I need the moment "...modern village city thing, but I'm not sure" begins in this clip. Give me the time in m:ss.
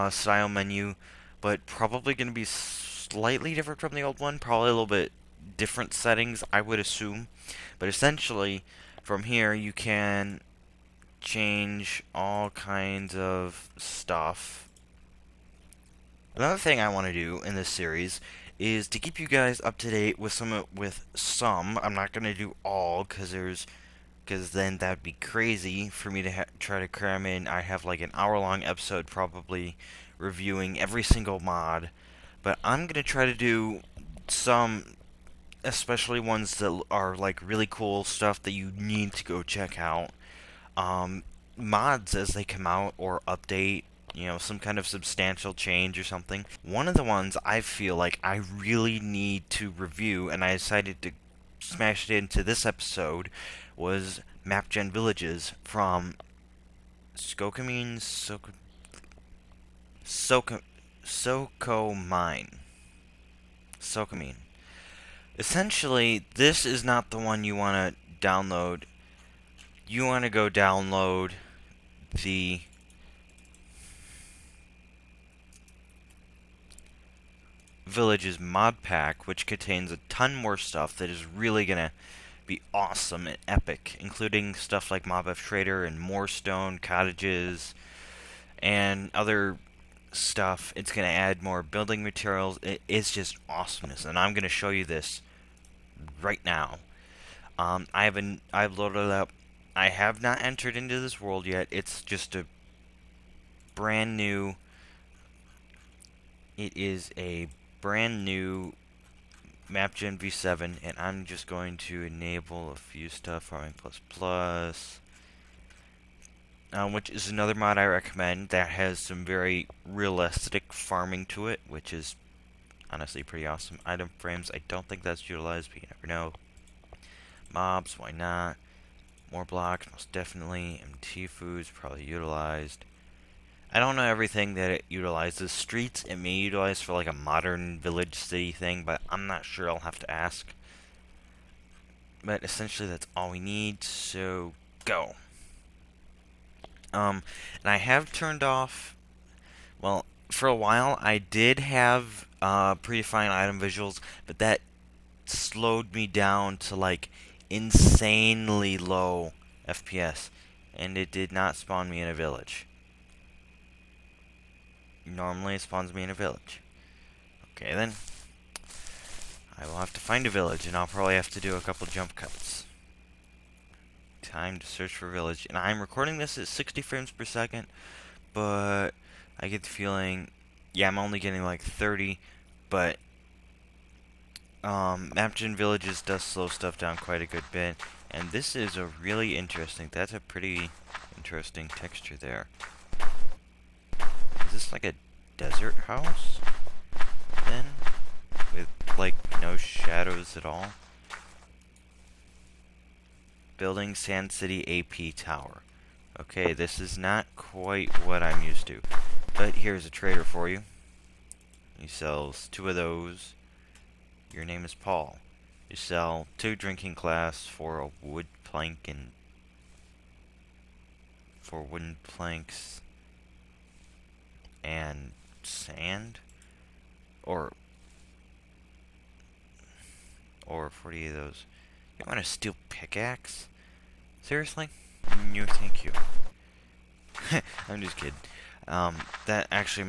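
2:17.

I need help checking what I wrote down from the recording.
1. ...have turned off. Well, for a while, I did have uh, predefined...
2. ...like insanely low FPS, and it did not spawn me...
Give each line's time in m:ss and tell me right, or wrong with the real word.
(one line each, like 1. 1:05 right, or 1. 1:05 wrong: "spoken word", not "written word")
1. 2:27 right
2. 2:36 right.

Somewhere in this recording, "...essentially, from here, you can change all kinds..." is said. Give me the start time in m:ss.
0:07.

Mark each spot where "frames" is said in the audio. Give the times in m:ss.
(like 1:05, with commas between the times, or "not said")
2:04, 2:56.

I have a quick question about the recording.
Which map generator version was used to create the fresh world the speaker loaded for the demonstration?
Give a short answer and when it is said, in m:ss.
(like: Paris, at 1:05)
v7, at 1:49.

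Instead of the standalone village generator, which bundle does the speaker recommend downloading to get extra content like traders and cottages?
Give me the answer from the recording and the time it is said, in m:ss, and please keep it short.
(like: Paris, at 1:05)
Villages mod pack, at 1:17.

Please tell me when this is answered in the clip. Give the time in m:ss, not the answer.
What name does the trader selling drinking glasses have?
3:34.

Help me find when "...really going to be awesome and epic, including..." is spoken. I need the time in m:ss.
1:21.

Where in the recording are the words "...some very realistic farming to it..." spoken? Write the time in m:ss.
1:59.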